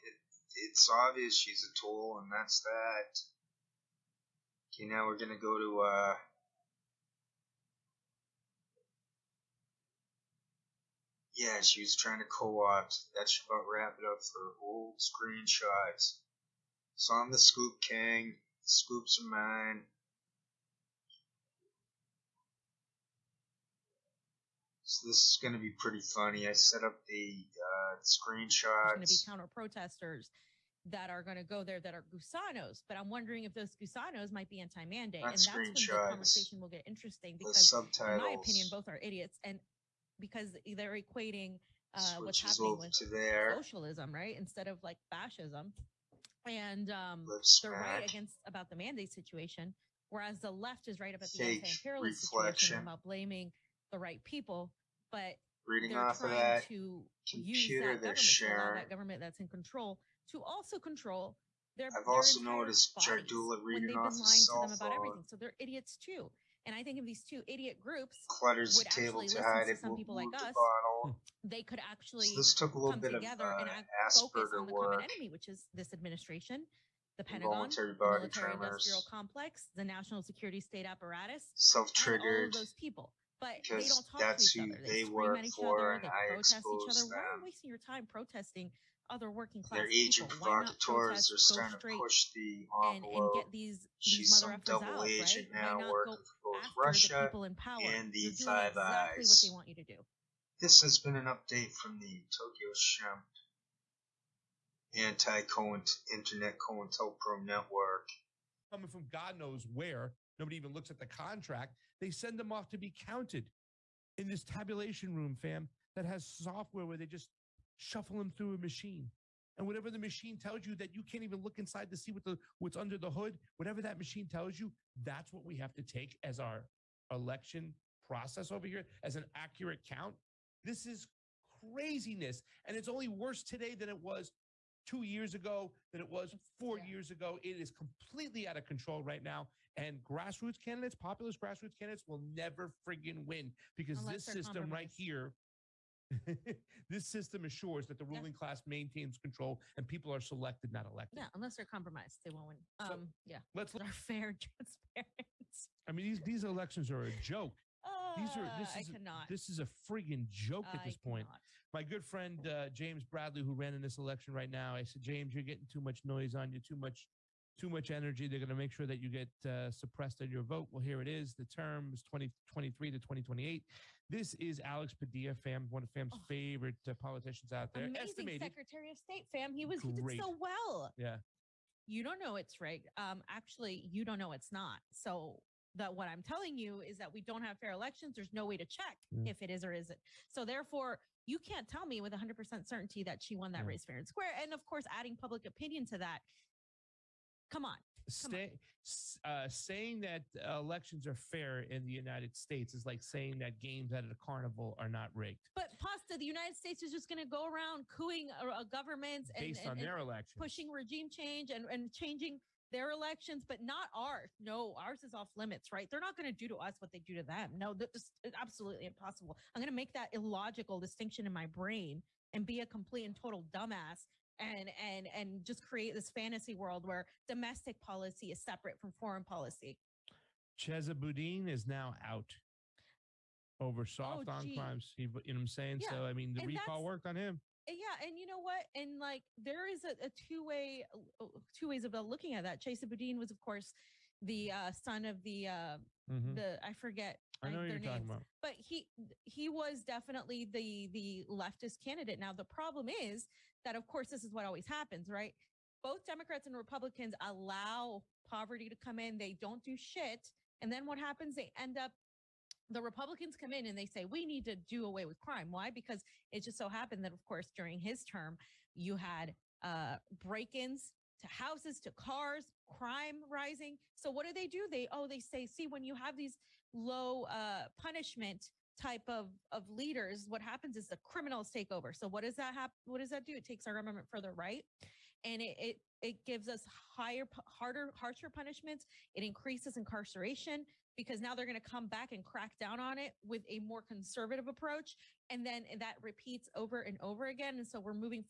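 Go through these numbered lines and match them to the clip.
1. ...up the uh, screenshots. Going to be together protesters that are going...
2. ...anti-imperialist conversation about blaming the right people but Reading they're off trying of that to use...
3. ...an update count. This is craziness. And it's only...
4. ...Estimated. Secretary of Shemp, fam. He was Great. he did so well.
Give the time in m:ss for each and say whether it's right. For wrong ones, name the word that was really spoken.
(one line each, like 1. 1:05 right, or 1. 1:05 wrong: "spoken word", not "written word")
1. 0:26 wrong: "counter", not "together"
2. 0:51 wrong: "situation", not "conversation"
3. 2:09 wrong: "accurate", not "update"
4. 2:58 wrong: "State", not "Shemp".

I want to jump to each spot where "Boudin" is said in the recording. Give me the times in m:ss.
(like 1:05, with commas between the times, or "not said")
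3:50, 4:02.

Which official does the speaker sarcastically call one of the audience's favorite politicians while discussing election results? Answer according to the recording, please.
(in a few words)
Alex Padilla.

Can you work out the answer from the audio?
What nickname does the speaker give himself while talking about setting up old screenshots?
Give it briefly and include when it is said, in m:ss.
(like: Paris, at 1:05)
The Scoop King, at 0:17.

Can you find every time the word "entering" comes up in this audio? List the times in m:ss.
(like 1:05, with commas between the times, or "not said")
not said.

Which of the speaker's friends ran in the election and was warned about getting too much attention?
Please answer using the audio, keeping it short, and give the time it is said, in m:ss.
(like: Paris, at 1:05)
James Bradley, at 2:42.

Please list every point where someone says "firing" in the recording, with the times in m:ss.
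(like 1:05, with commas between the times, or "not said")
not said.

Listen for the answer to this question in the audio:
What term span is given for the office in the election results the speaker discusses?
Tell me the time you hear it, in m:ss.
2:52.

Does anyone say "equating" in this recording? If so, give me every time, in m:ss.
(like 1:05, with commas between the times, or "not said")
0:40.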